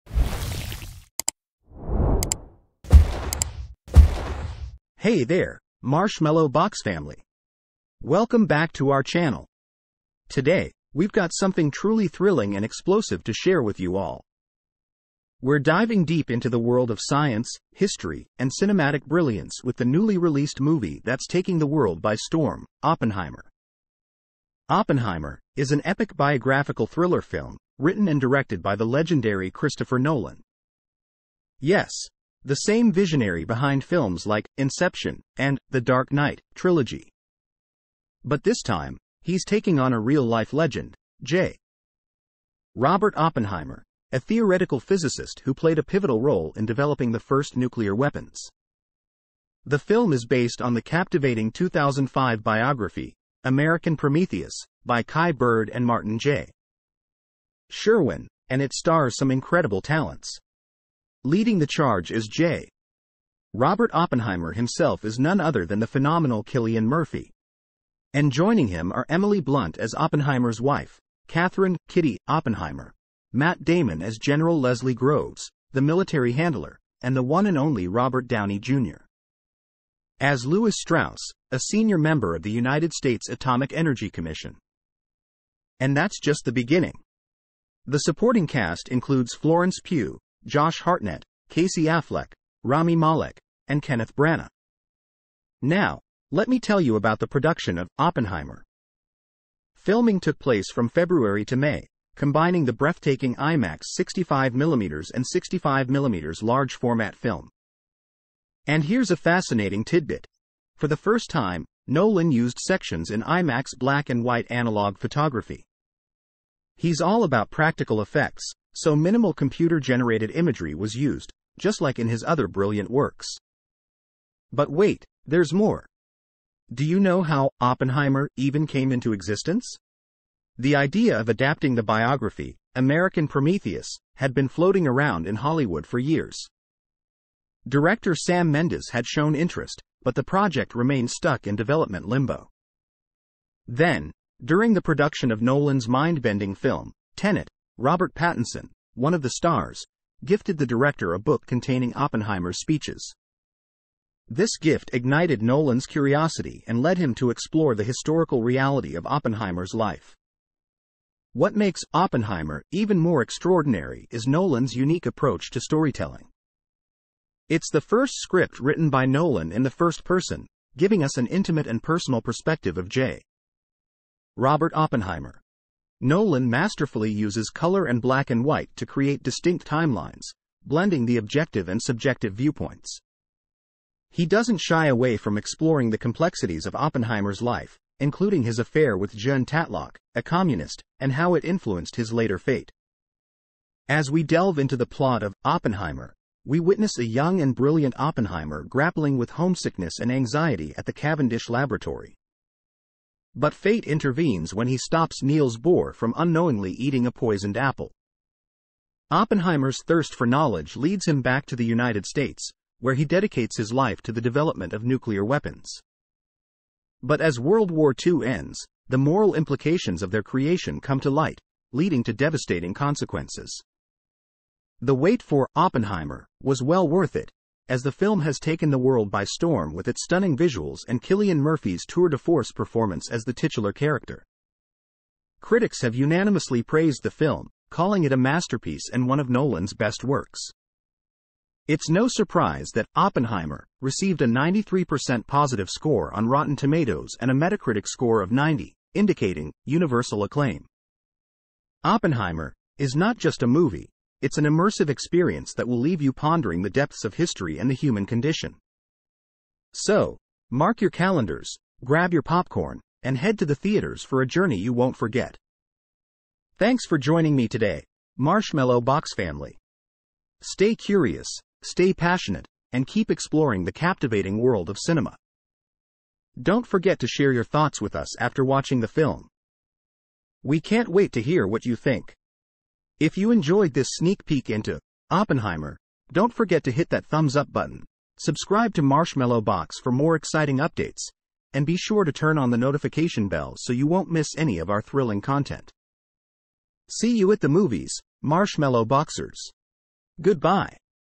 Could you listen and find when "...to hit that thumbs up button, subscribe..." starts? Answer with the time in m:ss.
4:46.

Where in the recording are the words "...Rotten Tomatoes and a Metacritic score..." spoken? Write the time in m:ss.
4:06.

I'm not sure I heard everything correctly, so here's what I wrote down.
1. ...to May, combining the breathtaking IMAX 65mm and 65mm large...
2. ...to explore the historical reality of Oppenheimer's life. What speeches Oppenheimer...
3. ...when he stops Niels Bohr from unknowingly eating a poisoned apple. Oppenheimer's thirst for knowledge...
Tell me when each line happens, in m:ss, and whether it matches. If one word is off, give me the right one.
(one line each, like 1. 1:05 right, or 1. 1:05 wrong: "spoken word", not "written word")
1. 1:41 right
2. 2:37 wrong: "makes", not "speeches"
3. 3:24 right.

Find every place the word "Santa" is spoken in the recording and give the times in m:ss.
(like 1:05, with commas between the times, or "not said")
not said.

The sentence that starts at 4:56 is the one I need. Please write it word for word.
See you at the movies, Marshmallow Boxers.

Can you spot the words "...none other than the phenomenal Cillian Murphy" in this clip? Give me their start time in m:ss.
1:05.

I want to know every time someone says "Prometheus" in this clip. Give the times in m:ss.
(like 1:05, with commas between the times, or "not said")
0:53, 2:13.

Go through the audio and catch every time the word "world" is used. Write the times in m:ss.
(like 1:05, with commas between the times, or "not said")
0:16, 0:21, 3:37, 3:48, 4:34.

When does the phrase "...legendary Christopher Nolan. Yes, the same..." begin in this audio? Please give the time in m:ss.
0:28.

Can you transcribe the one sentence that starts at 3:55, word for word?
Critics have unanimously praised the film, calling it a masterpiece and one of Nolan's best works.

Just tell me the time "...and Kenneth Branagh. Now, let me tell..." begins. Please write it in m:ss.
1:33.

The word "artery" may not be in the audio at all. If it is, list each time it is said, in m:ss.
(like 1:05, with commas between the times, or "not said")
not said.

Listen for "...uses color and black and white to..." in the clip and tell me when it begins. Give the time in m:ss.
2:57.